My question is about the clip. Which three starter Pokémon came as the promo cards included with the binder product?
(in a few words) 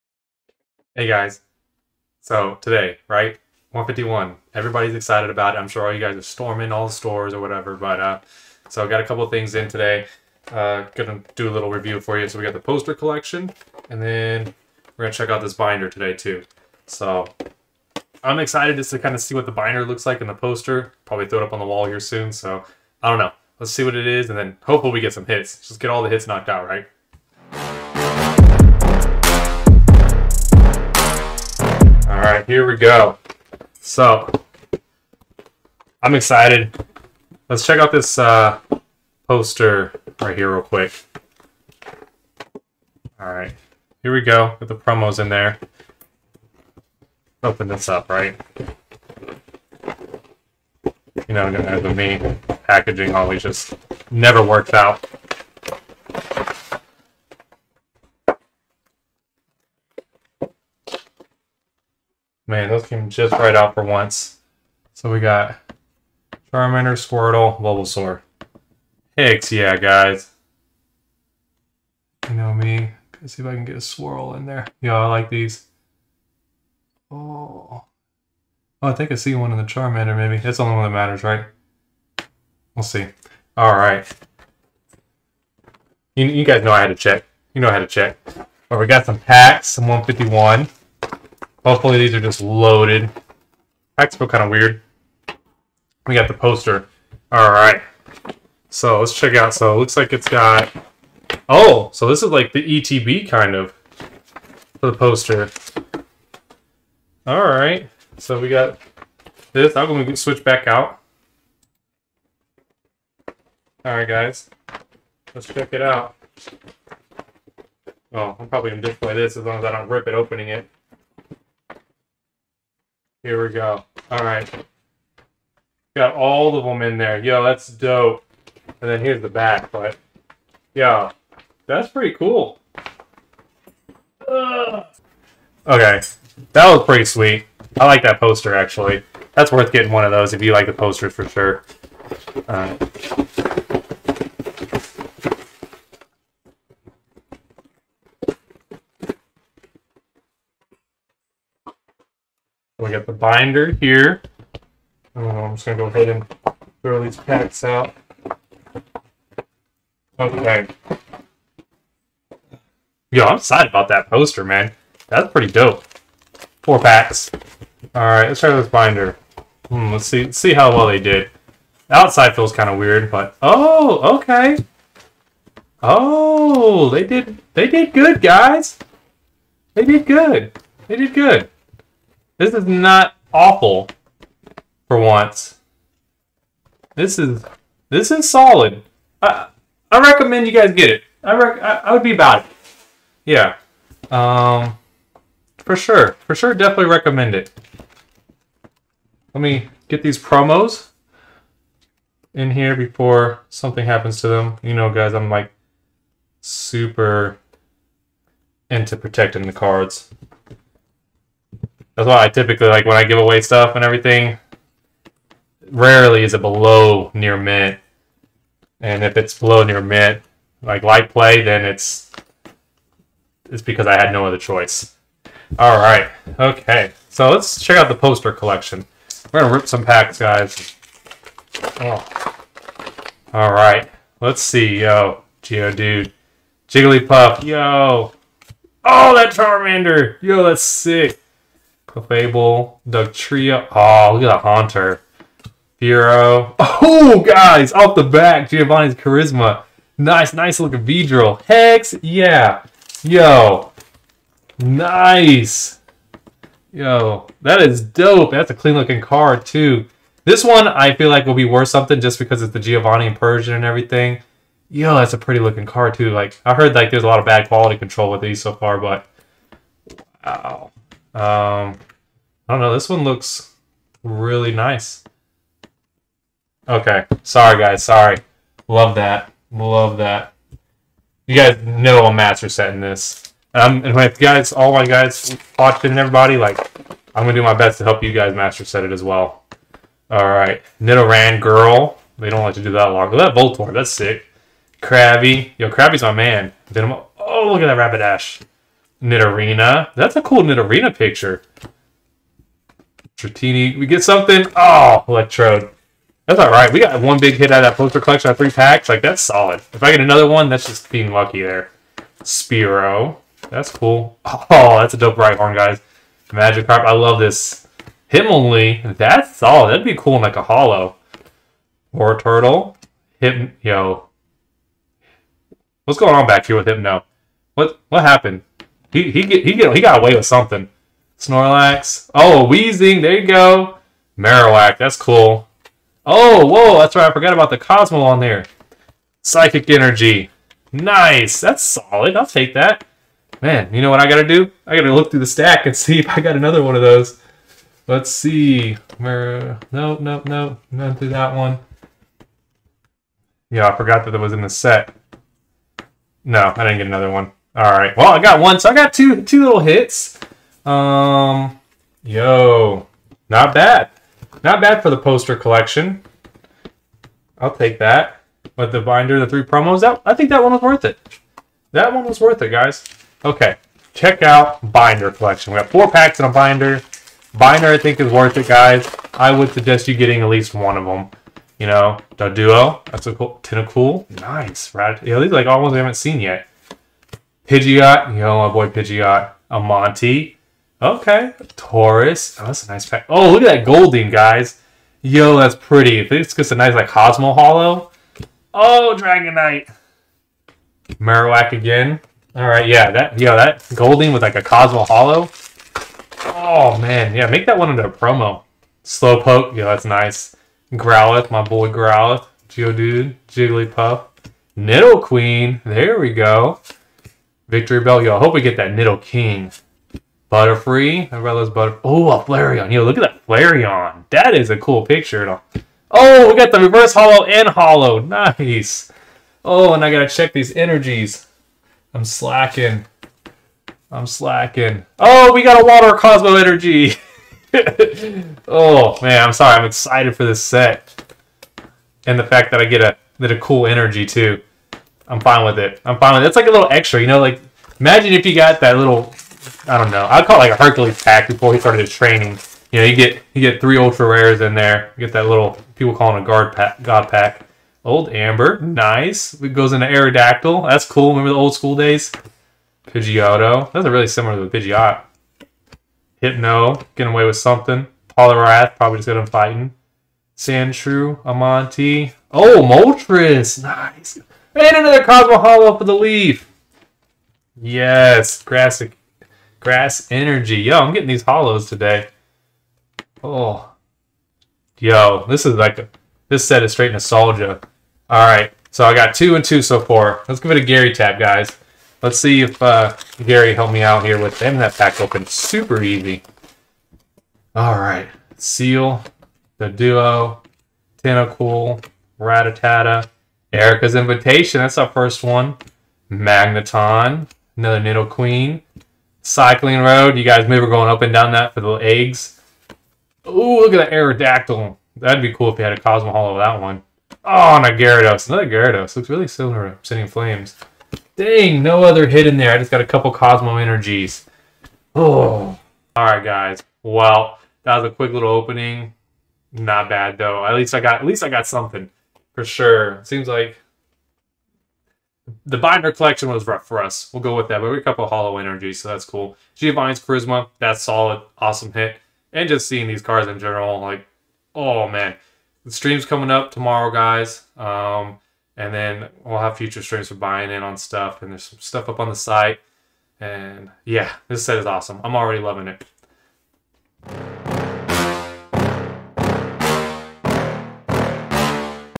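Charmander, Squirtle, Bulbasaur.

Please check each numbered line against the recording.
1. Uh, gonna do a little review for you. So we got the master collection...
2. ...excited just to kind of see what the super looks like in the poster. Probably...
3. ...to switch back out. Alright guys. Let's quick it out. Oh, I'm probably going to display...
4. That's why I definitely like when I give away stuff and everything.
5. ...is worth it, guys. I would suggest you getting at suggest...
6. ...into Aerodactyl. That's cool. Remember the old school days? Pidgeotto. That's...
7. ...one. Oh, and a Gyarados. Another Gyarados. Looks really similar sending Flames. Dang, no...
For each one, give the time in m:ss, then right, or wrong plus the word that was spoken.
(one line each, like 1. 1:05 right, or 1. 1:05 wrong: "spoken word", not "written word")
1. 0:10 wrong: "poster", not "master"
2. 0:18 wrong: "binder", not "super"
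3. 1:50 wrong: "check", not "quick"
4. 3:31 wrong: "typically", not "definitely"
5. 6:17 wrong: "least", not "suggest"
6. 7:39 right
7. 8:36 right.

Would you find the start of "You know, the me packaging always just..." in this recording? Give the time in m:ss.
0:51.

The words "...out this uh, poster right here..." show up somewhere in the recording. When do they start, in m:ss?
0:37.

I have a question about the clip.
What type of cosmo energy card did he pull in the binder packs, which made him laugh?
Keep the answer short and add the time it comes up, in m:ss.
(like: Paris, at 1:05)
Water, at 7:15.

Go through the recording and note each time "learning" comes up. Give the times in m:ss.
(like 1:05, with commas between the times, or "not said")
not said.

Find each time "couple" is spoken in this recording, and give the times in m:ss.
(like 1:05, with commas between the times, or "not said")
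0:09, 8:42, 8:57.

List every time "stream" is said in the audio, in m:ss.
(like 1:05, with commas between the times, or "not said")
9:05, 9:09.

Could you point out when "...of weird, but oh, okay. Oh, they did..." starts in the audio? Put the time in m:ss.
2:52.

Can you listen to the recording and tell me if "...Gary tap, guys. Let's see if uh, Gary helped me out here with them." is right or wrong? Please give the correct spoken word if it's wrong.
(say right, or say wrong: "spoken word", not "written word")
right.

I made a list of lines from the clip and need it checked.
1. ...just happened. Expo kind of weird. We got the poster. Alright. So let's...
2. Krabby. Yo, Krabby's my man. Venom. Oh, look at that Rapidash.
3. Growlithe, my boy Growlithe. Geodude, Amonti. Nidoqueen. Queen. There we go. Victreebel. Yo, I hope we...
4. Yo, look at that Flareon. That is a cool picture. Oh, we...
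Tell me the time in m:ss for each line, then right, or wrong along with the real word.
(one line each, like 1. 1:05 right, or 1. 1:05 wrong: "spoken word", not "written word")
1. 1:32 wrong: "loaded", not "happened"
2. 4:54 right
3. 6:50 wrong: "Jigglypuff", not "Amonti"
4. 7:02 right.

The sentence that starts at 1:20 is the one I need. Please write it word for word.
That's the only one that matters, right?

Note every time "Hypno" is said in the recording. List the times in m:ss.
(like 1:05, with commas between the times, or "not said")
5:26, 7:46.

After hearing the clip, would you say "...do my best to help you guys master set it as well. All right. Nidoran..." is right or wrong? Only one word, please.
right.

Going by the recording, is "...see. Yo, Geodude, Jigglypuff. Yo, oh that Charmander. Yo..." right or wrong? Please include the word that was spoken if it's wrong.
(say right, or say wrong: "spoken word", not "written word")
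right.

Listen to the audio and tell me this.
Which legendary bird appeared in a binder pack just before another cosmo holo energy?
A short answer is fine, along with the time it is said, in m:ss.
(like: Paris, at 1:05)
Moltres, at 7:52.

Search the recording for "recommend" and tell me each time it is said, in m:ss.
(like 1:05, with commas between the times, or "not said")
3:09, 3:16.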